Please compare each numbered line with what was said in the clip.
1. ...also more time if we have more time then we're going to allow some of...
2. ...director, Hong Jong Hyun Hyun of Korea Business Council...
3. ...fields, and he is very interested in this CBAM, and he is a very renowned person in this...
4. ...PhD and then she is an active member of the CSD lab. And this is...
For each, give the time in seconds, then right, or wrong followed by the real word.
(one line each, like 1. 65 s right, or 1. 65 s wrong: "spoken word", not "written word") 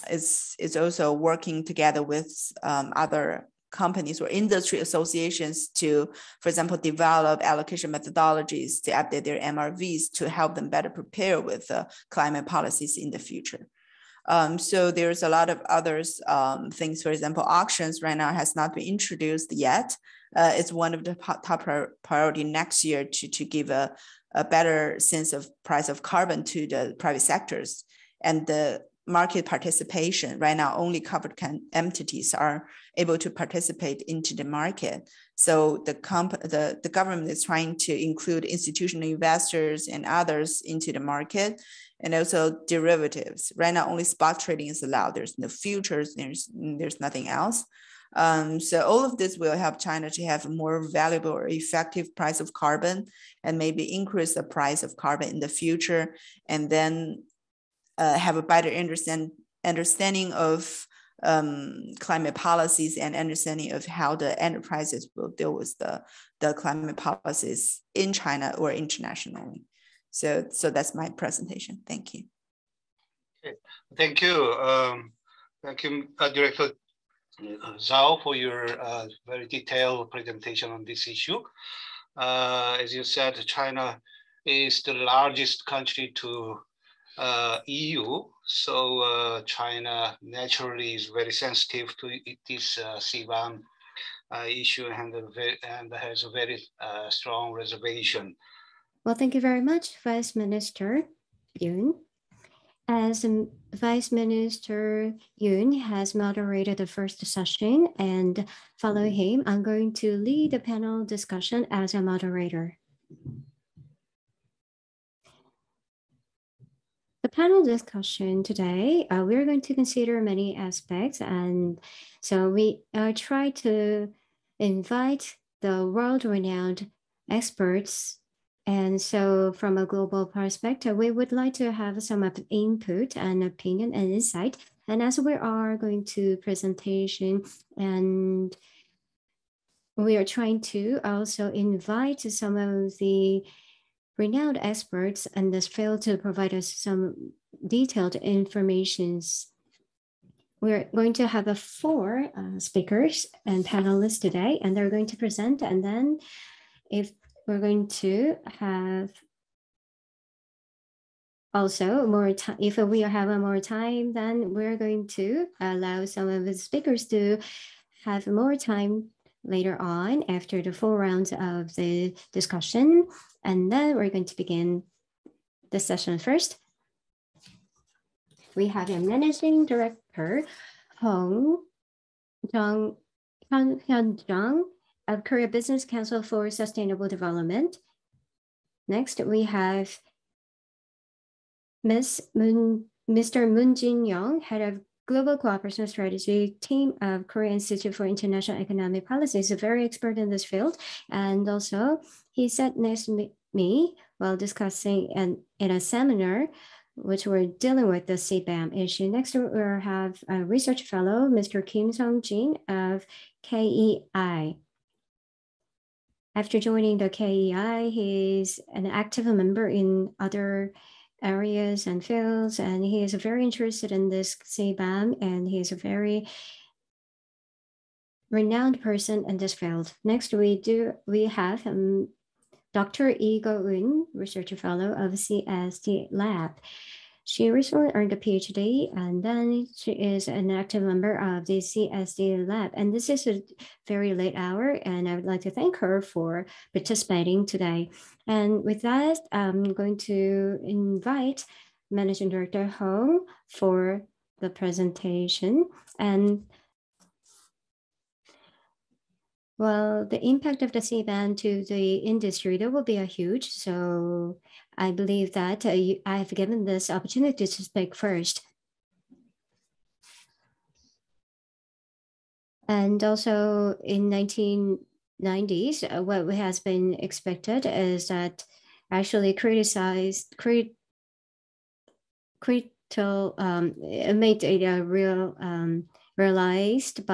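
1. 161 s right
2. 179 s right
3. 222 s right
4. 238 s right.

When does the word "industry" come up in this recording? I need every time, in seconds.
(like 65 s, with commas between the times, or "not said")
4 s, 261 s.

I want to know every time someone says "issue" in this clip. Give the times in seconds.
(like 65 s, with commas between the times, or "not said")
81 s, 94 s, 208 s.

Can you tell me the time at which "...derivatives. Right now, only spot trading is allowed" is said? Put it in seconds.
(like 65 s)
42 s.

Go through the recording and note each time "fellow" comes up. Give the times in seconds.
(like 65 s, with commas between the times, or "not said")
210 s, 234 s.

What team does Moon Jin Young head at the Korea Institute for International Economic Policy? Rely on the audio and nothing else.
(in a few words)
Global Cooperation Strategy team.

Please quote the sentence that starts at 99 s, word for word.
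Well, thank you very much, Vice Minister Yun.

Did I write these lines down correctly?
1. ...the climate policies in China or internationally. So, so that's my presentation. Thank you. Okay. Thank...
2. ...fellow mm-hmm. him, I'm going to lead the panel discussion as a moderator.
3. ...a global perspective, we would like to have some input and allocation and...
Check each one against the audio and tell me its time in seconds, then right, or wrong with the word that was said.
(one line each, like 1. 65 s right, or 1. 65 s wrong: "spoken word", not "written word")
1. 66 s right
2. 108 s wrong: "follow", not "fellow"
3. 129 s wrong: "opinion", not "allocation".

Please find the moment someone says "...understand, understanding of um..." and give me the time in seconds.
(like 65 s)
58 s.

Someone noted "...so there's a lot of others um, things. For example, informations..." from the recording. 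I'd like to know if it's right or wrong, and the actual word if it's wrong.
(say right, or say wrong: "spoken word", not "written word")
wrong: "auctions", not "informations".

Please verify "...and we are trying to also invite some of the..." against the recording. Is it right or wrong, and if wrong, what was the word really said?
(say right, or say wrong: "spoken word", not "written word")
right.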